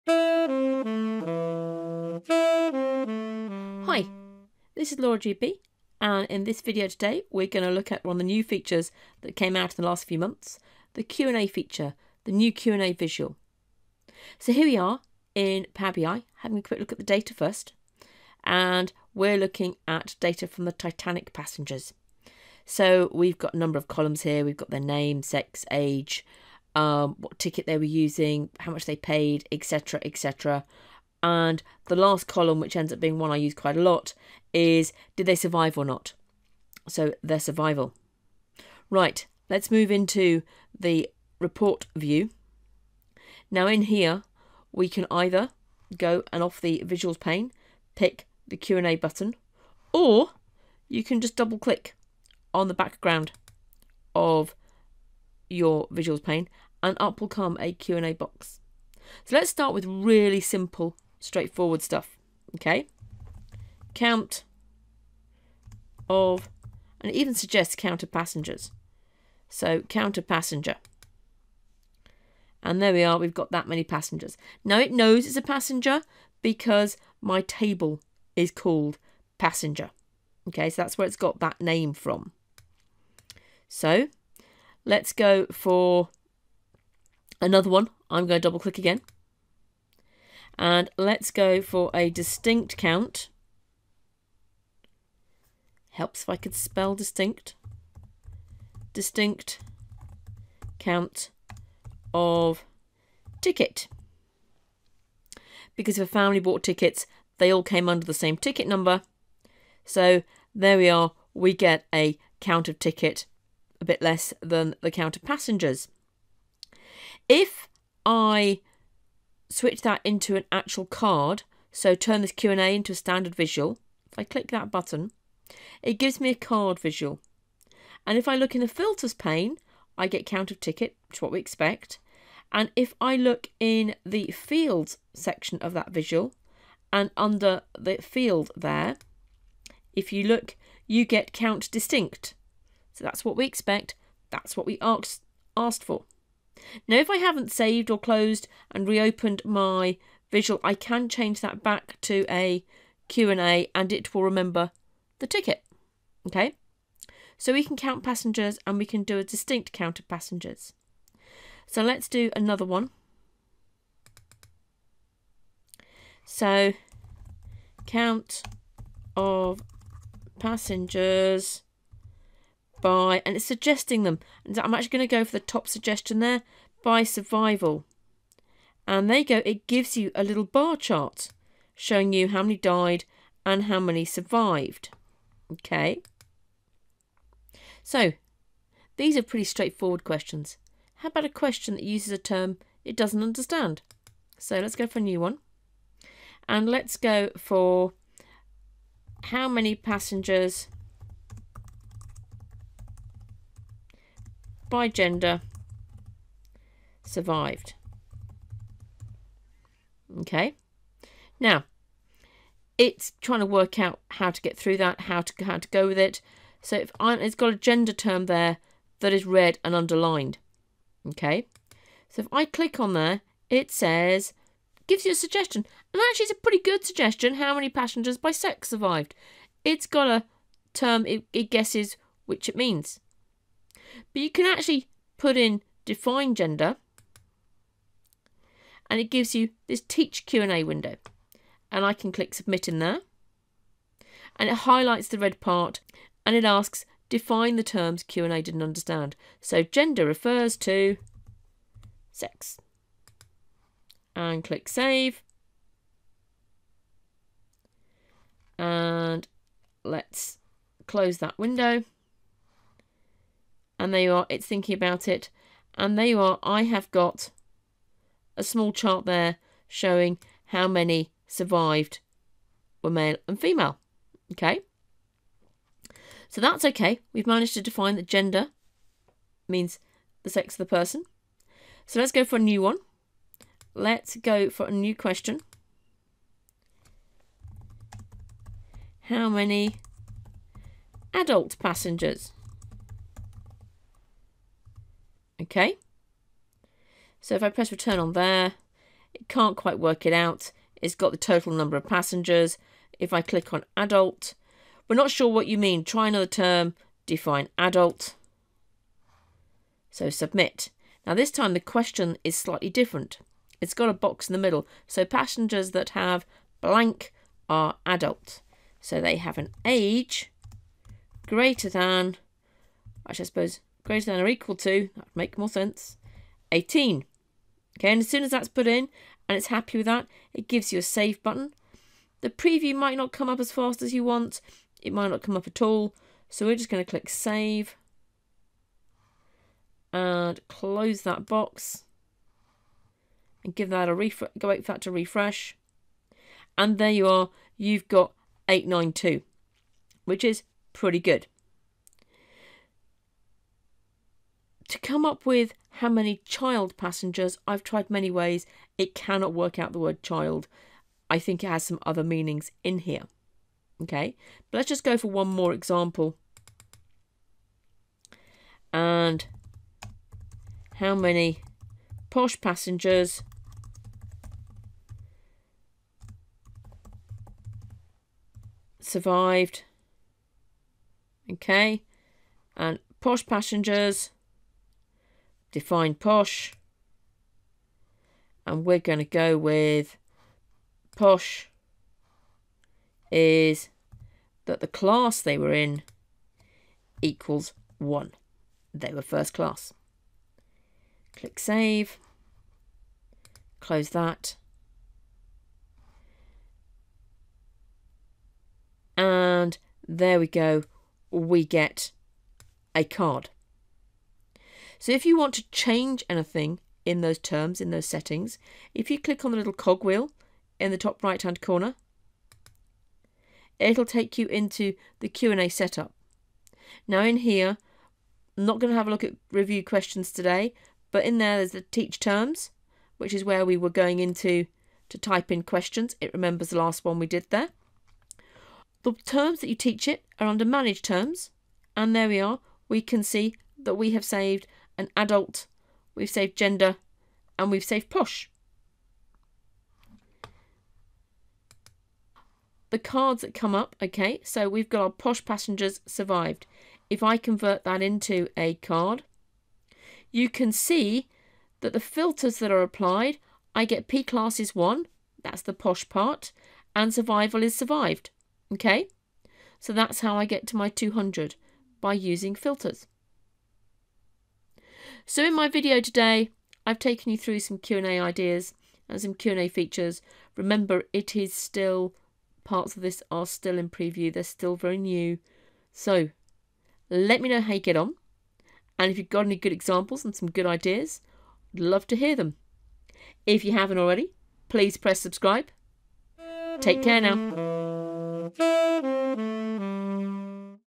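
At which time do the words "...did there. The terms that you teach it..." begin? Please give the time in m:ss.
7:17.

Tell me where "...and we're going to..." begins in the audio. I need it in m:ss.
6:28.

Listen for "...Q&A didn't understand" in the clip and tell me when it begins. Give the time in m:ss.
4:08.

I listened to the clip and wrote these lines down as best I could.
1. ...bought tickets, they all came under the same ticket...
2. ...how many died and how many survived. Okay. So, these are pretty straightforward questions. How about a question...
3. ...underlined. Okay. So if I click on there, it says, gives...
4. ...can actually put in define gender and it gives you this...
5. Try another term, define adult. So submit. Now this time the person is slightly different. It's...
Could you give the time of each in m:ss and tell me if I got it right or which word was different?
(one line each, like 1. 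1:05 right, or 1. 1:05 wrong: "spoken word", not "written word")
1. 1:46 right
2. 3:02 right
3. 3:39 right
4. 3:54 right
5. 5:05 wrong: "question", not "person".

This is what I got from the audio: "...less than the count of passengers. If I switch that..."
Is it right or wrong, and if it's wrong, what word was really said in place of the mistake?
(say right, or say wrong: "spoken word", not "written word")
right.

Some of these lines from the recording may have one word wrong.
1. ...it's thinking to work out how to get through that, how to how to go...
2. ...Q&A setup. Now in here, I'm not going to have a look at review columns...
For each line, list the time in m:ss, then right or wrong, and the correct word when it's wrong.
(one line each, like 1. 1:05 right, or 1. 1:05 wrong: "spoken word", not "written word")
1. 3:32 wrong: "trying", not "thinking"
2. 7:05 wrong: "questions", not "columns".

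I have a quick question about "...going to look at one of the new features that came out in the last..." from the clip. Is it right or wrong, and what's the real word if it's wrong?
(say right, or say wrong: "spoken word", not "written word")
right.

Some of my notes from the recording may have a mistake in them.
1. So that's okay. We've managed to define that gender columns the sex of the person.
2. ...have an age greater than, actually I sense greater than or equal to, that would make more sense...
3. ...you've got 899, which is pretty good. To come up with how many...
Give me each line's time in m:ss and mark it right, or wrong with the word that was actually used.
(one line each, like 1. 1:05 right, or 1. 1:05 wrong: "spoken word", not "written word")
1. 4:36 wrong: "means", not "columns"
2. 5:19 wrong: "suppose", not "sense"
3. 5:47 wrong: "892", not "899".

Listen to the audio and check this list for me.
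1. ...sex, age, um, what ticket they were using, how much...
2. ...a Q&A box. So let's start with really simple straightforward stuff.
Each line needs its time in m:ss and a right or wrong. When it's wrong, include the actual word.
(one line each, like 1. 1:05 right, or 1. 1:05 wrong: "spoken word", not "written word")
1. 0:25 right
2. 0:57 right.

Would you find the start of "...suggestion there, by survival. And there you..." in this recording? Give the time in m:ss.
2:55.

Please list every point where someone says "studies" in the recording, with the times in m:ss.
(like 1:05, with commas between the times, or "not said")
not said.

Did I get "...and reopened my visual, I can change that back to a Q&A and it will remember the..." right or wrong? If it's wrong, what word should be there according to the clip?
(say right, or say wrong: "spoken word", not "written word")
right.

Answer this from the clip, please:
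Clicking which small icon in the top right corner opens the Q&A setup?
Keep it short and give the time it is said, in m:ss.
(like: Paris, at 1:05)
cogwheel, at 6:59.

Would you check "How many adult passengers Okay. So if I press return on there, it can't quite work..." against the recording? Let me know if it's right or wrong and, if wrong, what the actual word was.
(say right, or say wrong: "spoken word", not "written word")
right.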